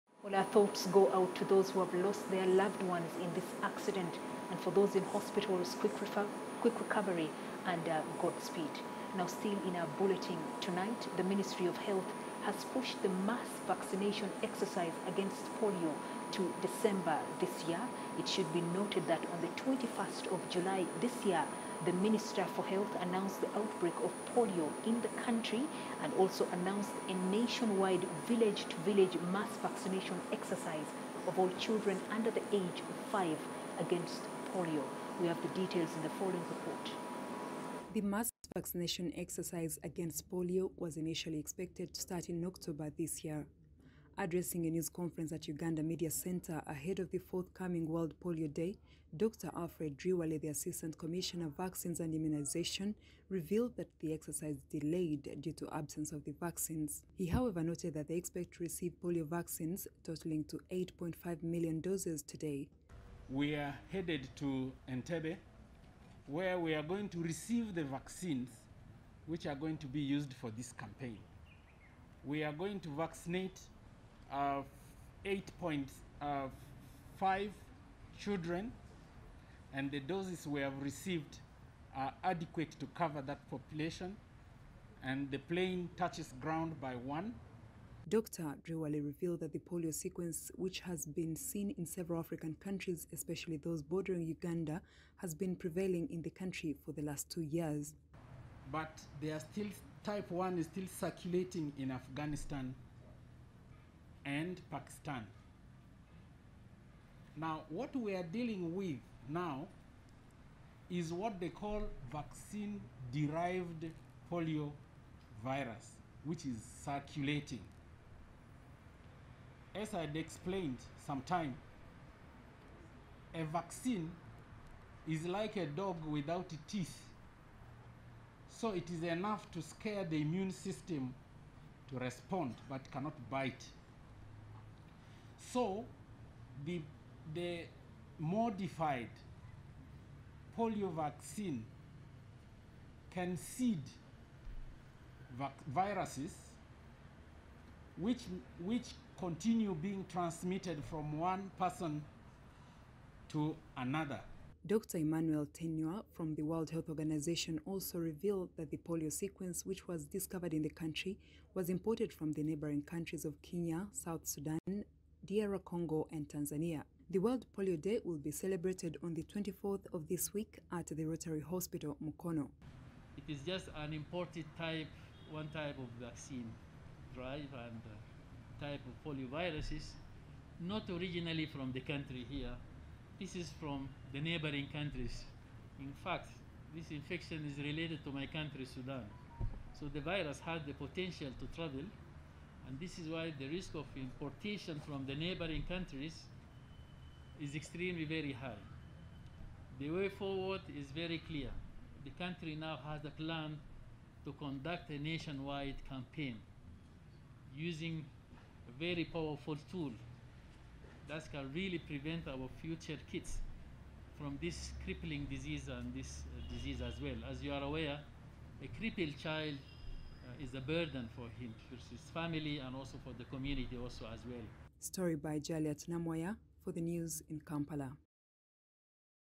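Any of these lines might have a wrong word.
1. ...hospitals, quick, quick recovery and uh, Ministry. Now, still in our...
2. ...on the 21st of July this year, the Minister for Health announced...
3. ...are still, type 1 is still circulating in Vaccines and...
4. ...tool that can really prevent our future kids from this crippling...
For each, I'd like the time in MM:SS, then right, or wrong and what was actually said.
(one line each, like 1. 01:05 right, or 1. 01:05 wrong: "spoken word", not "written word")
1. 00:05 wrong: "Godspeed", not "Ministry"
2. 00:19 right
3. 01:39 wrong: "Afghanistan", not "Vaccines"
4. 03:29 right.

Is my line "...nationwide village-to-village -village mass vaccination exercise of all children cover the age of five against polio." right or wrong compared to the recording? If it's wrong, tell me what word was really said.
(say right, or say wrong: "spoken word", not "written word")
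wrong: "under", not "cover".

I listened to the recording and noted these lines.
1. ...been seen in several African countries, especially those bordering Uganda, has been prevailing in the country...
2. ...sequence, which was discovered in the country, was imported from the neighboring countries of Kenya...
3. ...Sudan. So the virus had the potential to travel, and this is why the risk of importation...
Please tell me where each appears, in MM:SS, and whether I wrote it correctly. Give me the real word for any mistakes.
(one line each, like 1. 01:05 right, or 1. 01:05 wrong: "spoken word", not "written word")
1. 01:31 right
2. 02:39 right
3. 03:08 right.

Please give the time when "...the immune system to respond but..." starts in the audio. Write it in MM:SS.
02:10.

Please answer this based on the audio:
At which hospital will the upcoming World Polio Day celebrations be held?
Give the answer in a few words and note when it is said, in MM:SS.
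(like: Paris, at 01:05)
Rotary Hospital, Mukono, at 02:51.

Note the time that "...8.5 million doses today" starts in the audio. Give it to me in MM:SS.
01:00.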